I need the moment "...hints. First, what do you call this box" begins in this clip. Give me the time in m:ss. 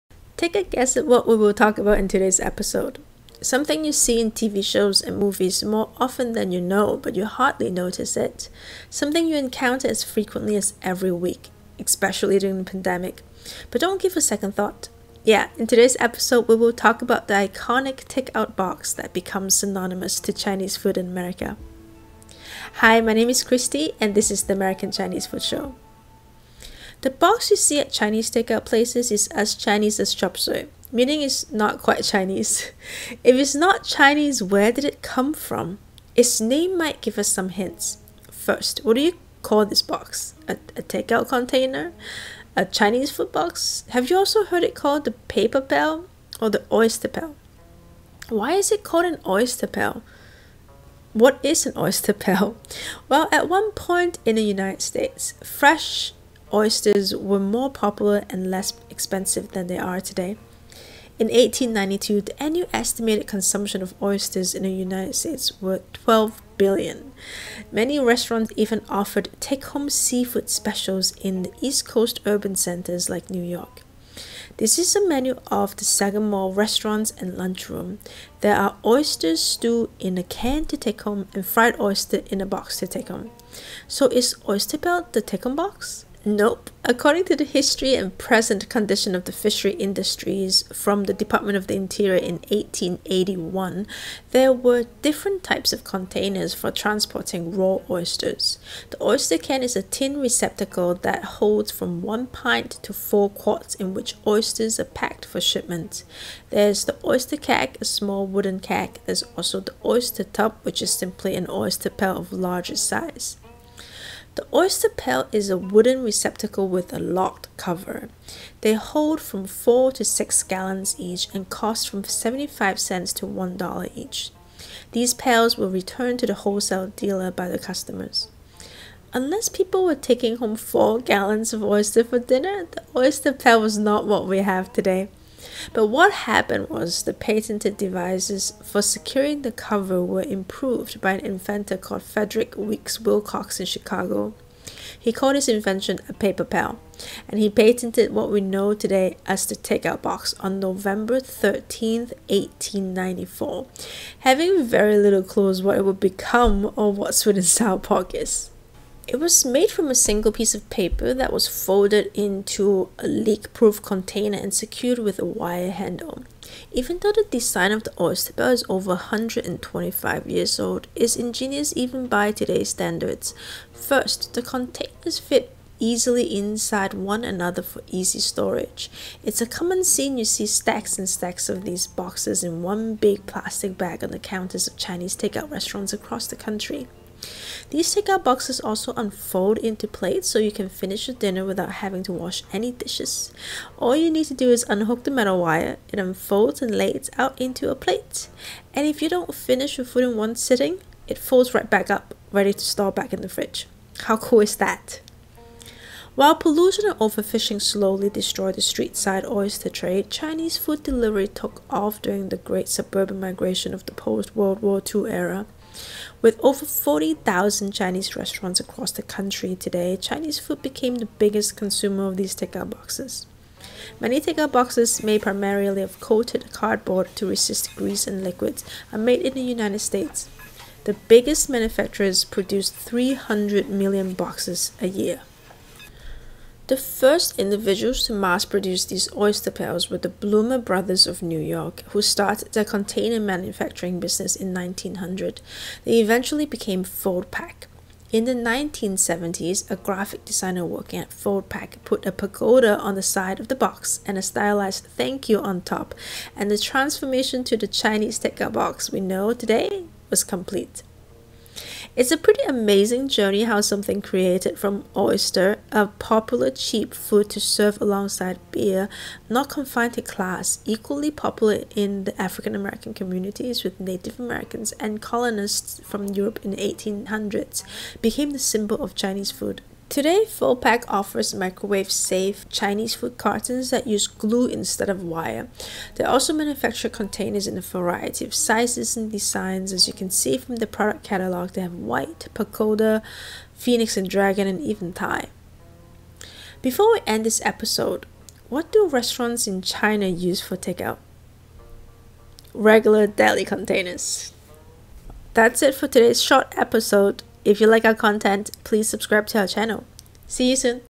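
0:37.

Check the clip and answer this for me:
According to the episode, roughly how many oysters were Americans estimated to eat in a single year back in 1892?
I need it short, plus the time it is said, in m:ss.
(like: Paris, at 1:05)
12 billion, at 1:05.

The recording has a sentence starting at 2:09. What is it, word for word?
Unless people were taking home 4 gallons of oyster for dinner, the oyster pail was not what we have today.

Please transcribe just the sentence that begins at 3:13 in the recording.
All you need to do is unhook the metal wire, it unfolds and lays out into a plate.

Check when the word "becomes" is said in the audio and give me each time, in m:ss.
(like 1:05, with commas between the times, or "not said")
0:19, 2:35.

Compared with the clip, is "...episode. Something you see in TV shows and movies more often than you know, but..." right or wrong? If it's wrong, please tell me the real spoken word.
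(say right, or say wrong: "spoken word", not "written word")
right.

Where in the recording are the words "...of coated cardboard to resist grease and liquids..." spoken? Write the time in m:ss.
3:45.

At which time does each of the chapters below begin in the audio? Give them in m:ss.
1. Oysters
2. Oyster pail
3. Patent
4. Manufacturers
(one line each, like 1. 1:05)
1. 0:26
2. 1:26
3. 2:19
4. 3:25.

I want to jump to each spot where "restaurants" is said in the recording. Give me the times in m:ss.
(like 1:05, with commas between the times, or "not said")
1:07, 1:16, 3:05, 3:38, 4:58.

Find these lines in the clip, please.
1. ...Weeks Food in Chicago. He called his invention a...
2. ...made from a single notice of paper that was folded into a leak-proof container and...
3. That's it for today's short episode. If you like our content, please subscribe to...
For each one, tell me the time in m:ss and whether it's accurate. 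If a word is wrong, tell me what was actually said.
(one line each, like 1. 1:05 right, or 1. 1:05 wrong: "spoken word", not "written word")
1. 2:22 wrong: "Wilcox", not "Food"
2. 2:39 wrong: "piece", not "notice"
3. 5:05 right.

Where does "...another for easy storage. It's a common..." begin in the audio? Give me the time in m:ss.
2:57.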